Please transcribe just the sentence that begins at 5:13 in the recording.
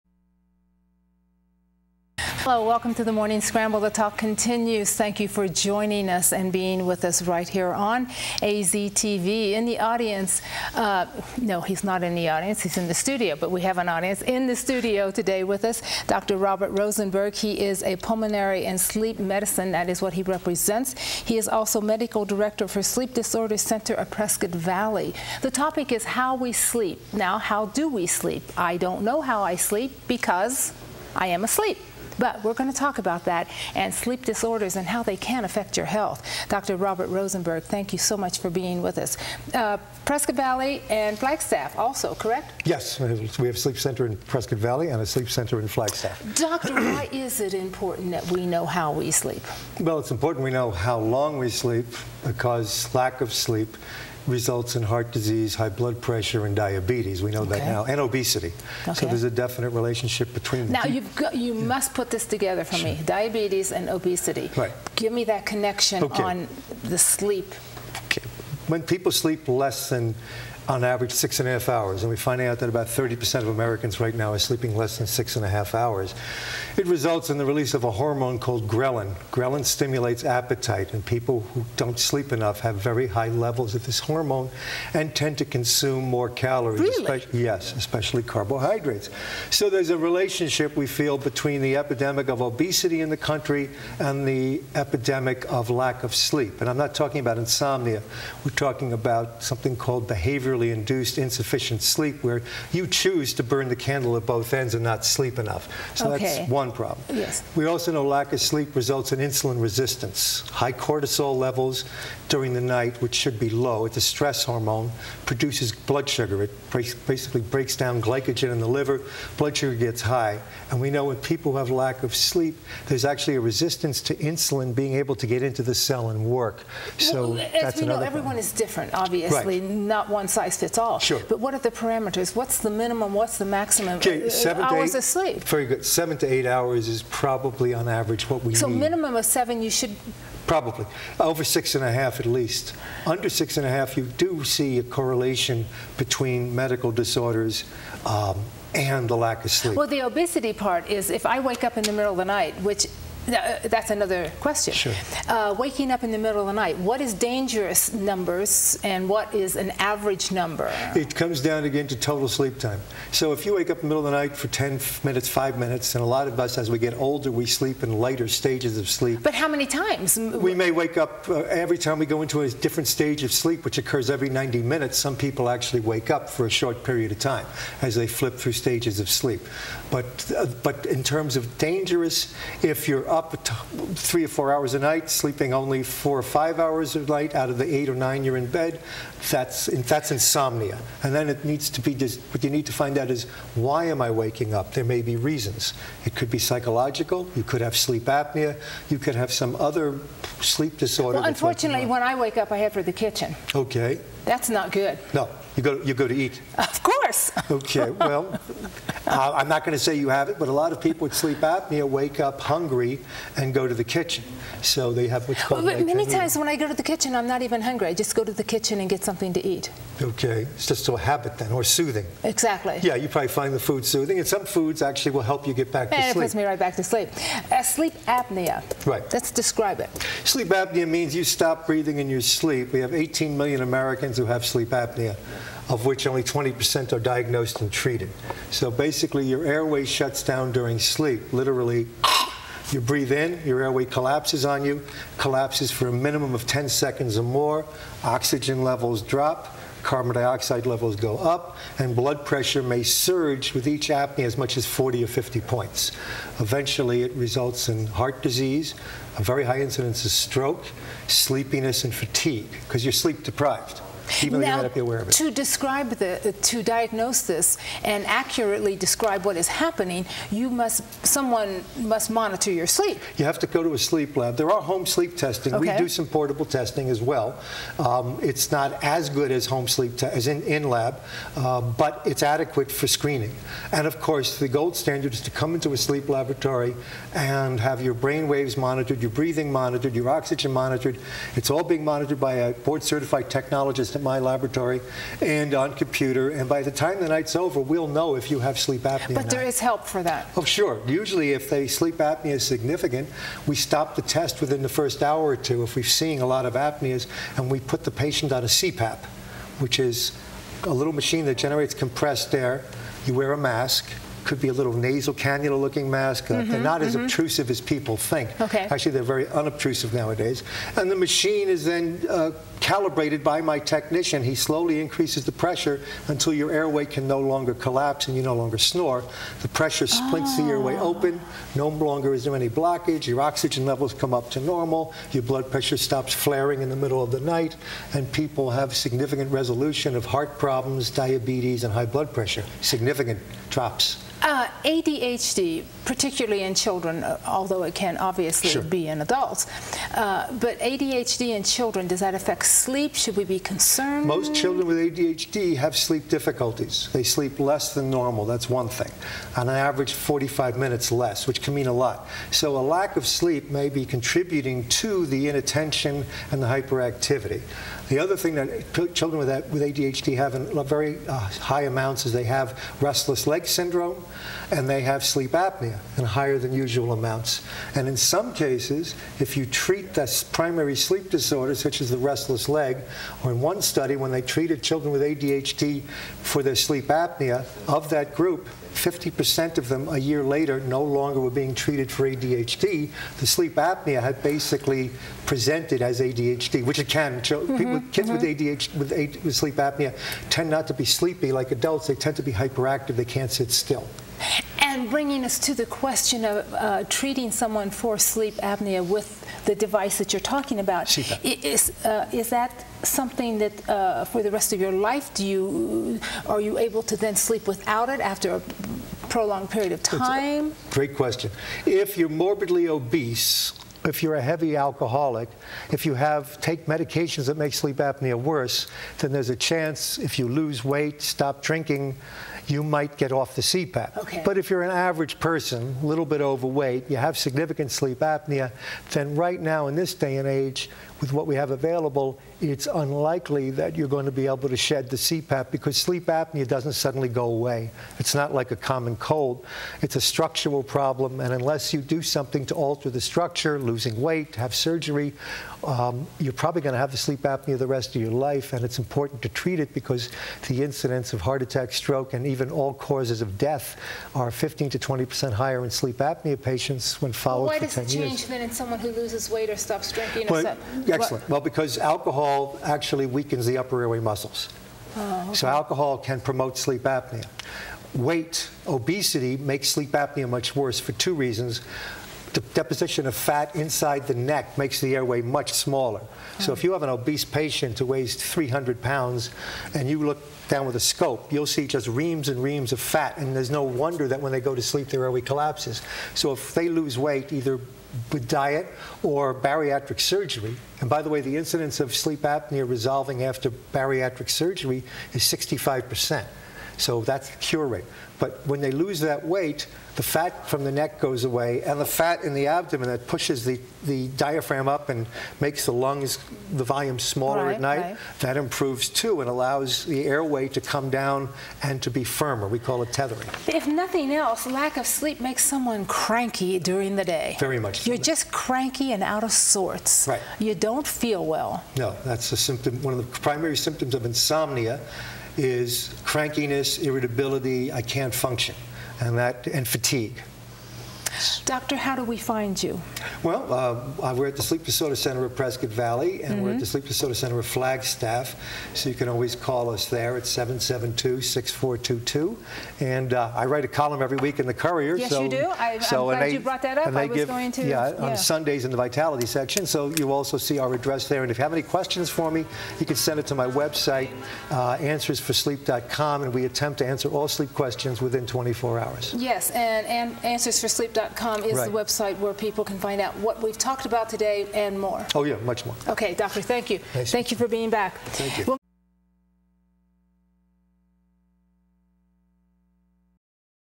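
You wear a mask, could be a little nasal cannula looking mask.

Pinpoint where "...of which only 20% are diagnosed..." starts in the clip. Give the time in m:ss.
3:55.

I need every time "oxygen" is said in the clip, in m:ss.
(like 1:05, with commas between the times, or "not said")
4:08, 4:50, 5:33.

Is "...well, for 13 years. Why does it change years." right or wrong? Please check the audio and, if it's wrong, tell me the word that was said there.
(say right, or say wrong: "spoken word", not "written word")
wrong: "10", not "13".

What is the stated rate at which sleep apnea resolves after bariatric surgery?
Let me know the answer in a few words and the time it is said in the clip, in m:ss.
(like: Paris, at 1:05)
65 percent, at 8:25.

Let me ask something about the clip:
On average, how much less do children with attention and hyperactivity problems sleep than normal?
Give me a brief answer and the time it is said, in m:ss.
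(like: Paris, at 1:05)
45 minutes, at 5:59.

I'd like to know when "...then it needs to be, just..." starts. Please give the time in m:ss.
3:11.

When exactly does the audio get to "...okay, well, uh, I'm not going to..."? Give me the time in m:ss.
3:27.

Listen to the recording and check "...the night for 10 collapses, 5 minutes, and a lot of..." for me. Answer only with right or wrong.
wrong.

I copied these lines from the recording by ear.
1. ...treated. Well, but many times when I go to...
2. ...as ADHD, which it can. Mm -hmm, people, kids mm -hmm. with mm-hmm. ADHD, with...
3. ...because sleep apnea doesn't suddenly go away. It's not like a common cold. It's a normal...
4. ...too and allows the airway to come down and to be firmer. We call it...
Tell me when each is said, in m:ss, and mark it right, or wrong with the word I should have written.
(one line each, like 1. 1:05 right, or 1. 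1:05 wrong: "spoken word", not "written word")
1. 3:35 wrong: "called", not "treated"
2. 6:35 right
3. 7:25 wrong: "structural", not "normal"
4. 8:38 right.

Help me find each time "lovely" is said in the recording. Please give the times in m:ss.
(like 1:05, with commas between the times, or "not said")
not said.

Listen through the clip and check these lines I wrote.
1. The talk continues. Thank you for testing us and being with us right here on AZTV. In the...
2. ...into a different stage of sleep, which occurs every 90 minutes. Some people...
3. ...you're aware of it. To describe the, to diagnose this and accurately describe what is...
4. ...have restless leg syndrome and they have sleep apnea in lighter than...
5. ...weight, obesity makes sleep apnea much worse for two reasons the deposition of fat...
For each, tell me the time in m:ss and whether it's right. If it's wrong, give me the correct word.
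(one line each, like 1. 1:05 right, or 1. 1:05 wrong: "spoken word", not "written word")
1. 0:03 wrong: "joining", not "testing"
2. 2:52 right
3. 4:24 right
4. 6:12 wrong: "higher", not "lighter"
5. 7:57 right.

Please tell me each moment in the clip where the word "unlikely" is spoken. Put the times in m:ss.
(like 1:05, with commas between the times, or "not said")
7:22.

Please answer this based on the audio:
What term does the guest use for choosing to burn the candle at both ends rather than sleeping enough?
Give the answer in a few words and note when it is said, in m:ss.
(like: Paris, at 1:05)
behavioral induced insufficient sleep, at 1:40.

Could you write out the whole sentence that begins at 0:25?
The topic is how we sleep.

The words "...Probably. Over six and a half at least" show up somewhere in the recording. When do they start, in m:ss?
2:20.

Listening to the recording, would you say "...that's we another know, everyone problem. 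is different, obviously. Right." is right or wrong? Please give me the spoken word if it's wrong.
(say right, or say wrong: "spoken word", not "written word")
right.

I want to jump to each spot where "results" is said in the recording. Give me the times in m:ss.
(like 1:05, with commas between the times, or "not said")
0:54, 1:16, 1:48, 4:17.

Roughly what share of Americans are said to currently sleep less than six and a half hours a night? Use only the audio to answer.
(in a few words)
30%.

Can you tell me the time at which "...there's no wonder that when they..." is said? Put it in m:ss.
8:13.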